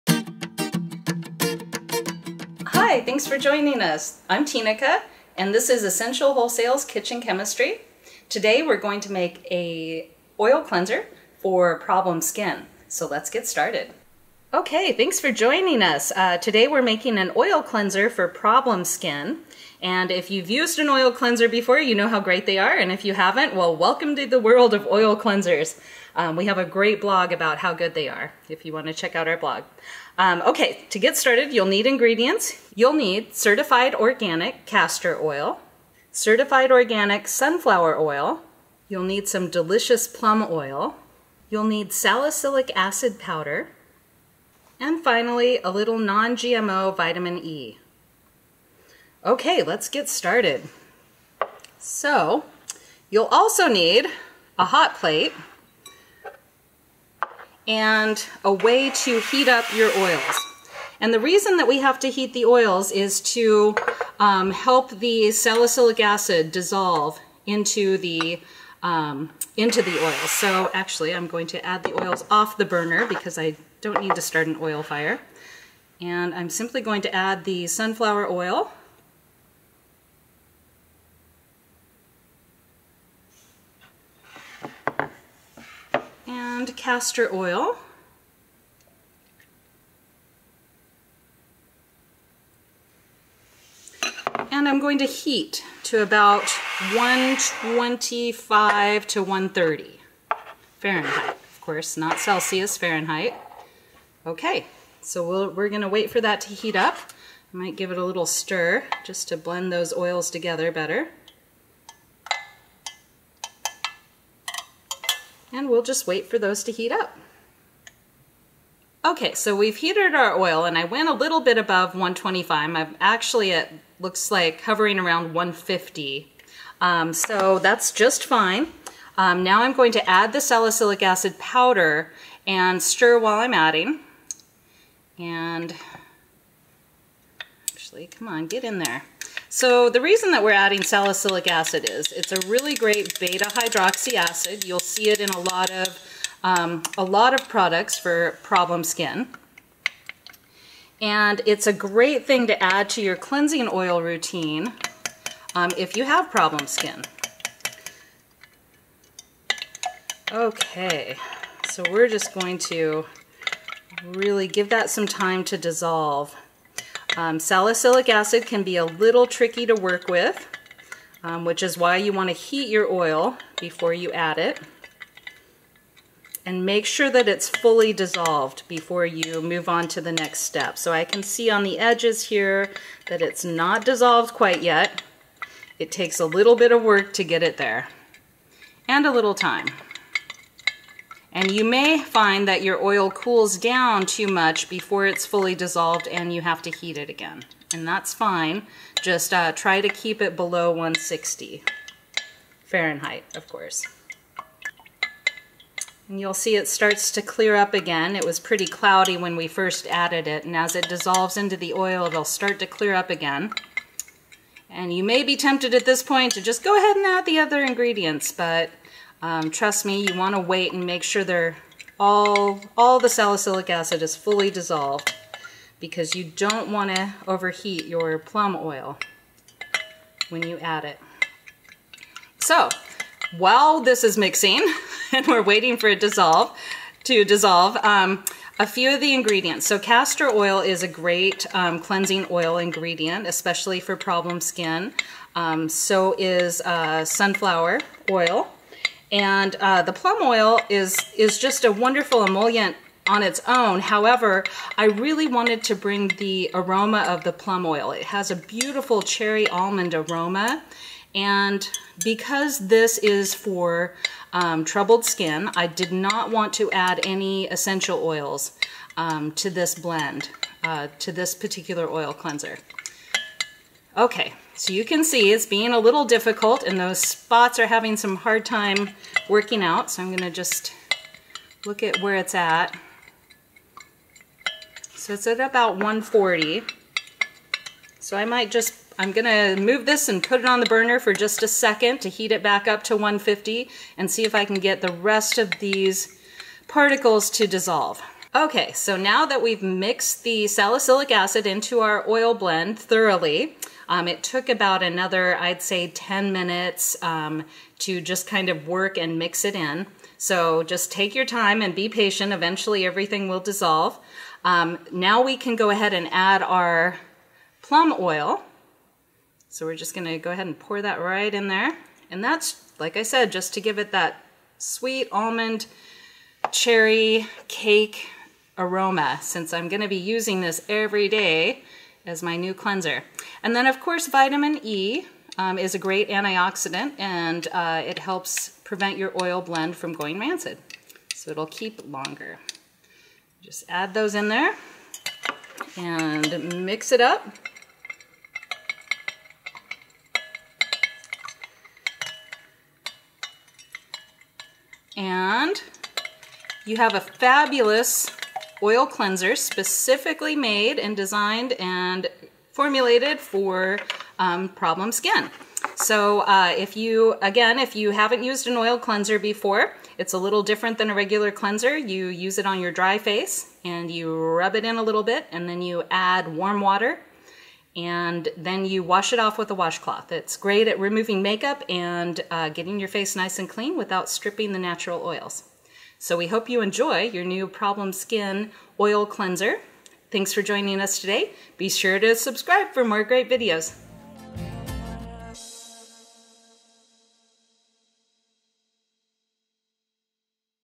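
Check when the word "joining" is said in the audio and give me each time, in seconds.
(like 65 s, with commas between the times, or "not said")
3 s, 15 s, 390 s.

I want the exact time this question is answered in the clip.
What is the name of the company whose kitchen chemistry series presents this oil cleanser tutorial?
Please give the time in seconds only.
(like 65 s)
5 s.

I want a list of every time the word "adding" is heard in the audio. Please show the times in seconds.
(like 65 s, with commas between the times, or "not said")
133 s, 140 s.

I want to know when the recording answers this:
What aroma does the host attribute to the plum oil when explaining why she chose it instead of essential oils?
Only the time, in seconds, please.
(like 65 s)
259 s.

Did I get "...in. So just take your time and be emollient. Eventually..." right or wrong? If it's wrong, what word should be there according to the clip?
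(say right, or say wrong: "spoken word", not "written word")
wrong: "patient", not "emollient".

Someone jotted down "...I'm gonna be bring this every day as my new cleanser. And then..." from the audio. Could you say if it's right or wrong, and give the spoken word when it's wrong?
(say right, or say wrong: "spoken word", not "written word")
wrong: "using", not "bring".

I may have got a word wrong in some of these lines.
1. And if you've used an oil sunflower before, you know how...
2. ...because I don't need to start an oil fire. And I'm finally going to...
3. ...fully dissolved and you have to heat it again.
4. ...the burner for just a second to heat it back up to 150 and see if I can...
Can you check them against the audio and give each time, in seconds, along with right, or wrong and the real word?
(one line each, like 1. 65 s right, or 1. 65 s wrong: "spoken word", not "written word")
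1. 19 s wrong: "cleanser", not "sunflower"
2. 73 s wrong: "simply", not "finally"
3. 195 s right
4. 290 s right.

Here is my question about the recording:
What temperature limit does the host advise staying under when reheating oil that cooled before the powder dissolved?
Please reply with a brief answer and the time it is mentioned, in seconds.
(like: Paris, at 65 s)
160 Fahrenheit, at 200 s.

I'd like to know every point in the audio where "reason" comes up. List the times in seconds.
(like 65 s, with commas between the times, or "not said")
61 s, 139 s.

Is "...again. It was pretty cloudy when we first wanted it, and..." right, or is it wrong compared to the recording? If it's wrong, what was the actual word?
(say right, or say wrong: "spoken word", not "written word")
wrong: "added", not "wanted".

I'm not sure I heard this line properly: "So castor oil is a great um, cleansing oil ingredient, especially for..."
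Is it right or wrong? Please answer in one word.
right.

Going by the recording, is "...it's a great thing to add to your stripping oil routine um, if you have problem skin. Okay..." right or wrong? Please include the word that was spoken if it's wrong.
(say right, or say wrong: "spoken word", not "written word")
wrong: "cleansing", not "stripping".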